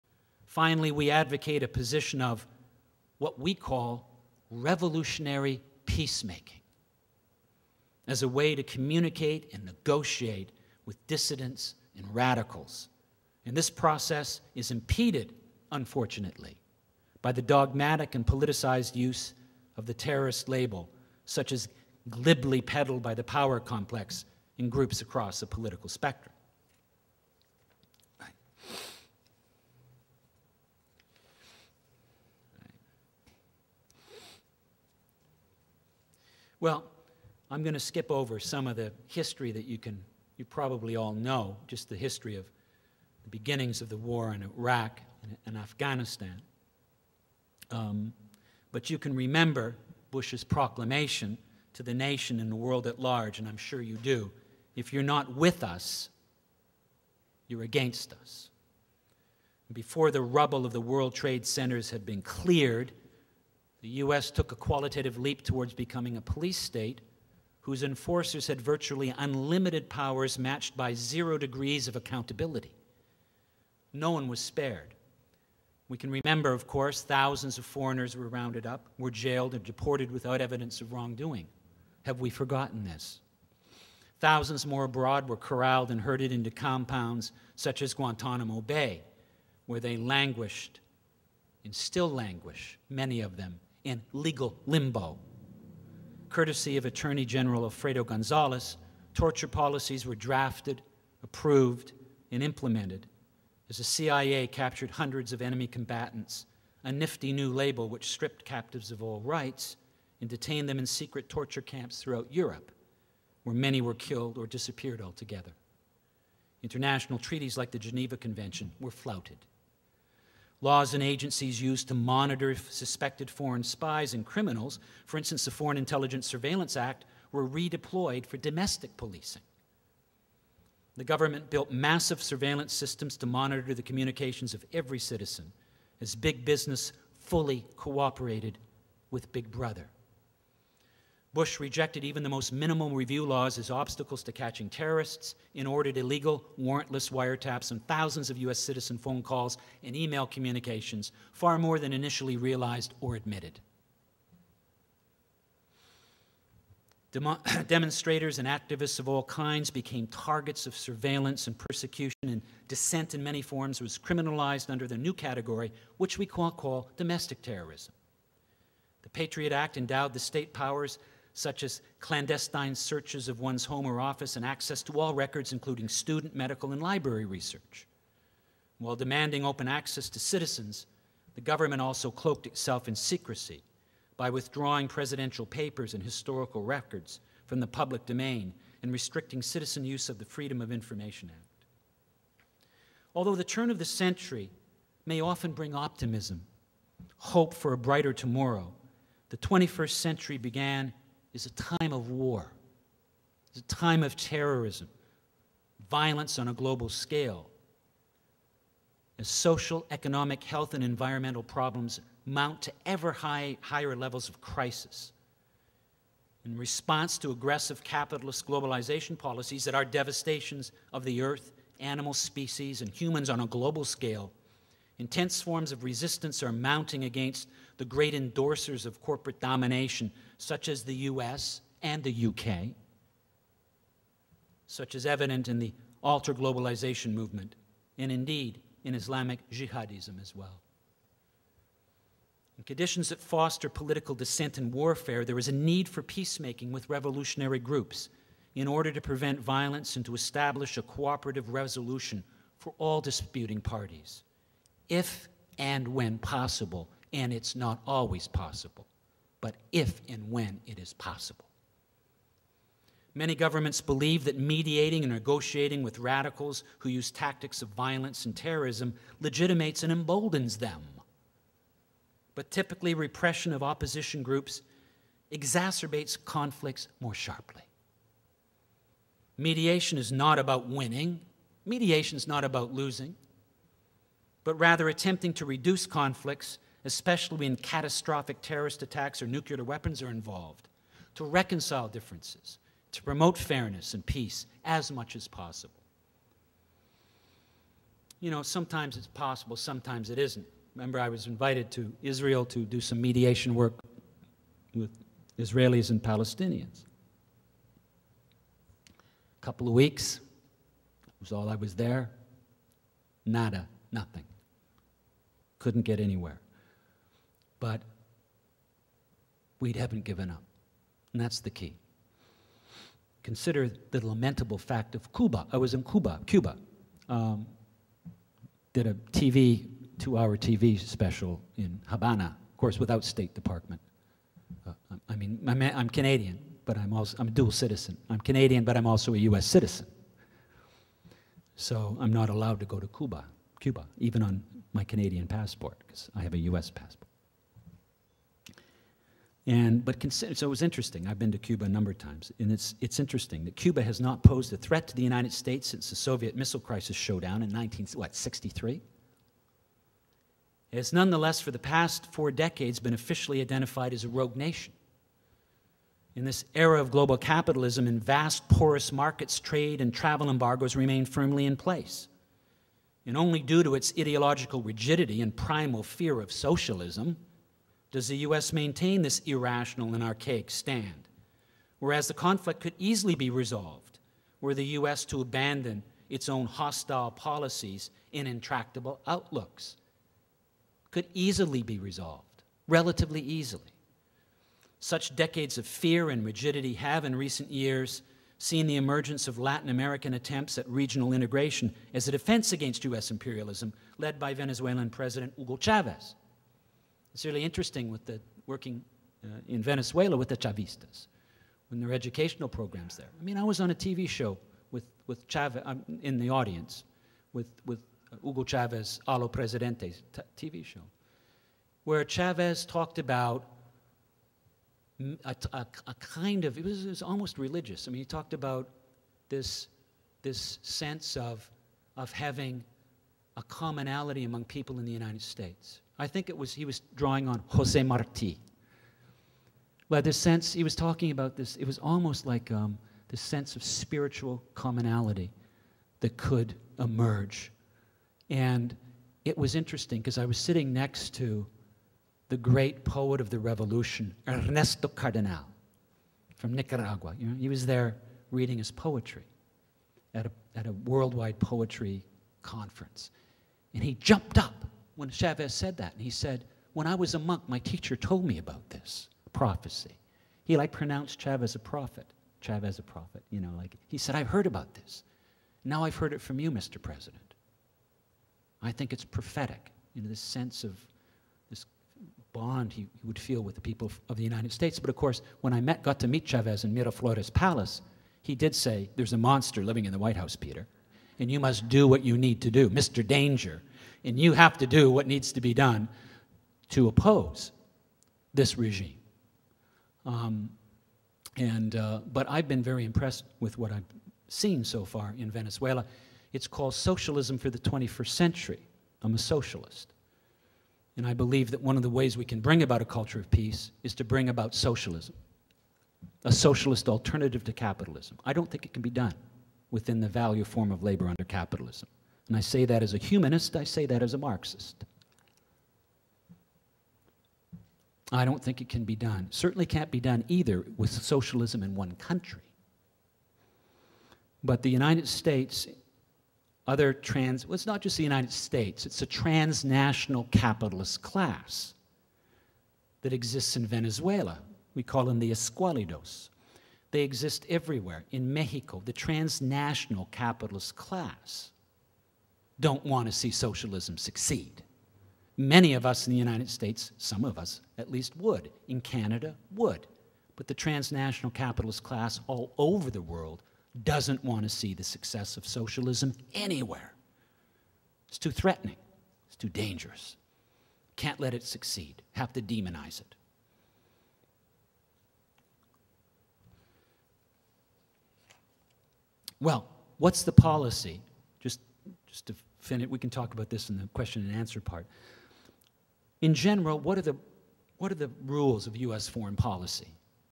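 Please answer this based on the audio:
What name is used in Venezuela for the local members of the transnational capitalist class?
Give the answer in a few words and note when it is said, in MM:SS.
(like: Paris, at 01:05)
escualidos, at 09:05.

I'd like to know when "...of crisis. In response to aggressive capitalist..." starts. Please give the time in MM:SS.
03:34.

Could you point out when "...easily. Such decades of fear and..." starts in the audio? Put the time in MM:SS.
06:33.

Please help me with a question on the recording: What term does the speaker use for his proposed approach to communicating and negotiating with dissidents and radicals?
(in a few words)
revolutionary peacemaking.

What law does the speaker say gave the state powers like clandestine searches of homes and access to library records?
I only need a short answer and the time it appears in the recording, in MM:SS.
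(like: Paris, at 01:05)
The Patriot Act, at 02:49.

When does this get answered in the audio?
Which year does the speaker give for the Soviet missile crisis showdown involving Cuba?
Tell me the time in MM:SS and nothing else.
05:57.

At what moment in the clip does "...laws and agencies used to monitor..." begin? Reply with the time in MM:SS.
02:00.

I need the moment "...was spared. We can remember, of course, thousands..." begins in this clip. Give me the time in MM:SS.
01:14.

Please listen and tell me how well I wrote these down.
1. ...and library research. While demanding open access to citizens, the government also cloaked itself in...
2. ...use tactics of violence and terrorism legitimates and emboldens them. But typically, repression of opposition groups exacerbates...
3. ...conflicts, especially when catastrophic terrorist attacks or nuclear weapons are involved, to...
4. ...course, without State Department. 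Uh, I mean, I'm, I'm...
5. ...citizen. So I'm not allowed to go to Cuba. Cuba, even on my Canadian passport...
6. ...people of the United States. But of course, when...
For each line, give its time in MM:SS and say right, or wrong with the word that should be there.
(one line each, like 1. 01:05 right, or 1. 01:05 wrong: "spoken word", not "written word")
1. 02:56 right
2. 04:26 right
3. 04:45 right
4. 05:32 right
5. 05:39 right
6. 08:03 right.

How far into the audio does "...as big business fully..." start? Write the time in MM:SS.
02:16.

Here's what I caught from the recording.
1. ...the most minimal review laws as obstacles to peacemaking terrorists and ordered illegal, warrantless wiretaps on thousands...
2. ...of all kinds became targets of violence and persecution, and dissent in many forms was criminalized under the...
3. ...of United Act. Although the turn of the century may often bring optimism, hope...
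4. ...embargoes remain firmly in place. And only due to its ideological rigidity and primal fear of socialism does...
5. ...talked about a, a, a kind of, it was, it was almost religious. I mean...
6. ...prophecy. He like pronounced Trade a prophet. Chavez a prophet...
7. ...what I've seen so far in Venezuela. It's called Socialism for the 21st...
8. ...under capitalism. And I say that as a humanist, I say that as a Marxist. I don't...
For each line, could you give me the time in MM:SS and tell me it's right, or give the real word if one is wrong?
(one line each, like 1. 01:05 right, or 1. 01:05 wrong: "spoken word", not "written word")
1. 02:22 wrong: "catching", not "peacemaking"
2. 02:38 wrong: "surveillance", not "violence"
3. 03:10 wrong: "Information", not "United"
4. 06:10 right
5. 07:02 right
6. 07:49 wrong: "Chavez", not "Trade"
7. 08:23 right
8. 08:41 right.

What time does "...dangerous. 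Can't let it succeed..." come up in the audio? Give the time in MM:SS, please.
09:29.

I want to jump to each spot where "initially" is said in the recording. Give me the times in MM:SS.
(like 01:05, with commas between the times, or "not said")
02:31.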